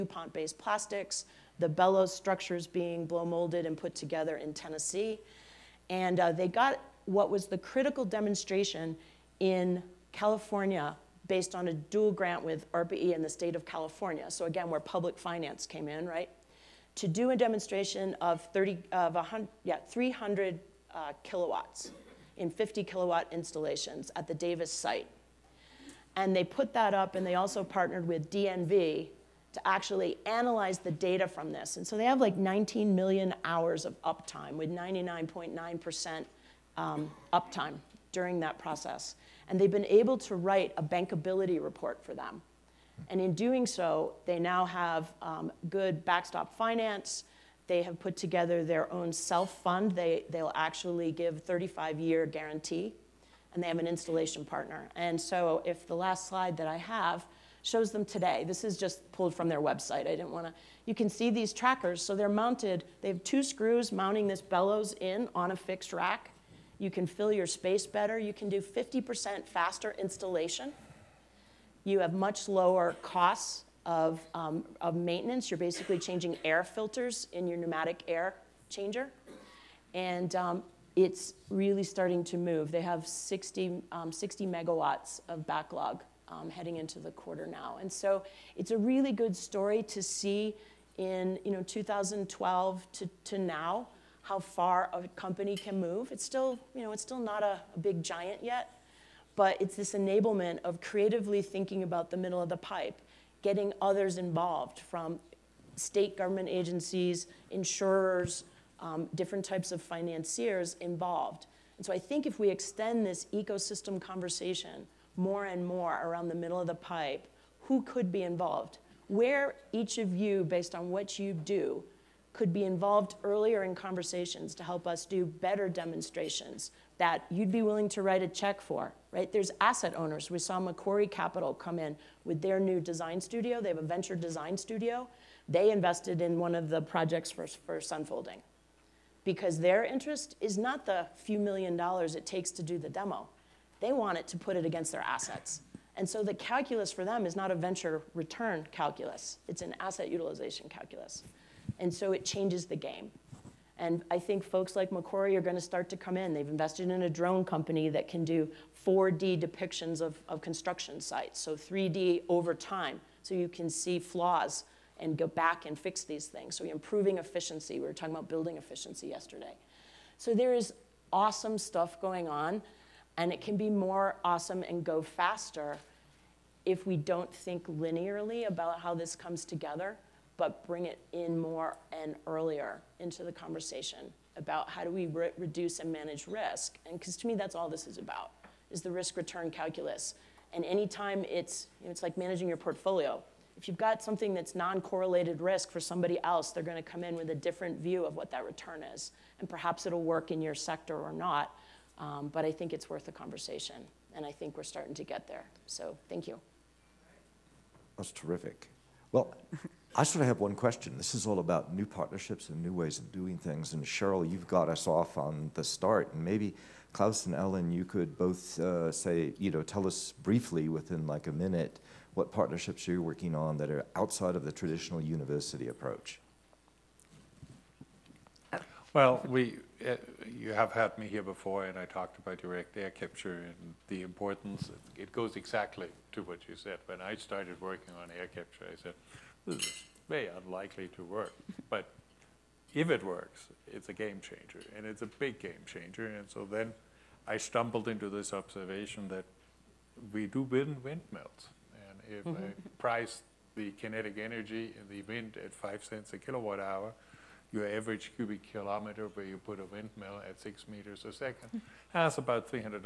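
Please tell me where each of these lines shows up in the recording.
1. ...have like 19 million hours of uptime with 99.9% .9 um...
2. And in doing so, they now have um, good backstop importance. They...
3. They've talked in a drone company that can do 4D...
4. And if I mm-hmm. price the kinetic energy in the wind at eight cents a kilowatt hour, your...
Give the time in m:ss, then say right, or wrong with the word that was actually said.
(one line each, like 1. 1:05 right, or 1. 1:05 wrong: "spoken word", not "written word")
1. 0:32 right
2. 0:43 wrong: "finance", not "importance"
3. 2:36 wrong: "invested", not "talked"
4. 4:11 wrong: "five", not "eight".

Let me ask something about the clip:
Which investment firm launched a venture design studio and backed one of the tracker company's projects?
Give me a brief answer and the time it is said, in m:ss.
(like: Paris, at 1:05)
Macquarie Capital, at 2:10.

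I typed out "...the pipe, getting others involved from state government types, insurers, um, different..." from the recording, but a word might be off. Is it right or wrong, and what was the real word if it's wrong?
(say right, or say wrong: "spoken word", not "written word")
wrong: "agencies", not "types".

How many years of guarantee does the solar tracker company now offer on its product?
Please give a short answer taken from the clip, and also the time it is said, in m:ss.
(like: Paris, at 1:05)
35, at 0:51.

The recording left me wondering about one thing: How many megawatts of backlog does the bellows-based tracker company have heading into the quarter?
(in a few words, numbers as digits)
60.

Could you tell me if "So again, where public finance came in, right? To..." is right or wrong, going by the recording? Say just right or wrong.
right.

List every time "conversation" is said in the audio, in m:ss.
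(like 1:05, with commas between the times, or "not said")
1:54, 2:03, 3:03, 3:23.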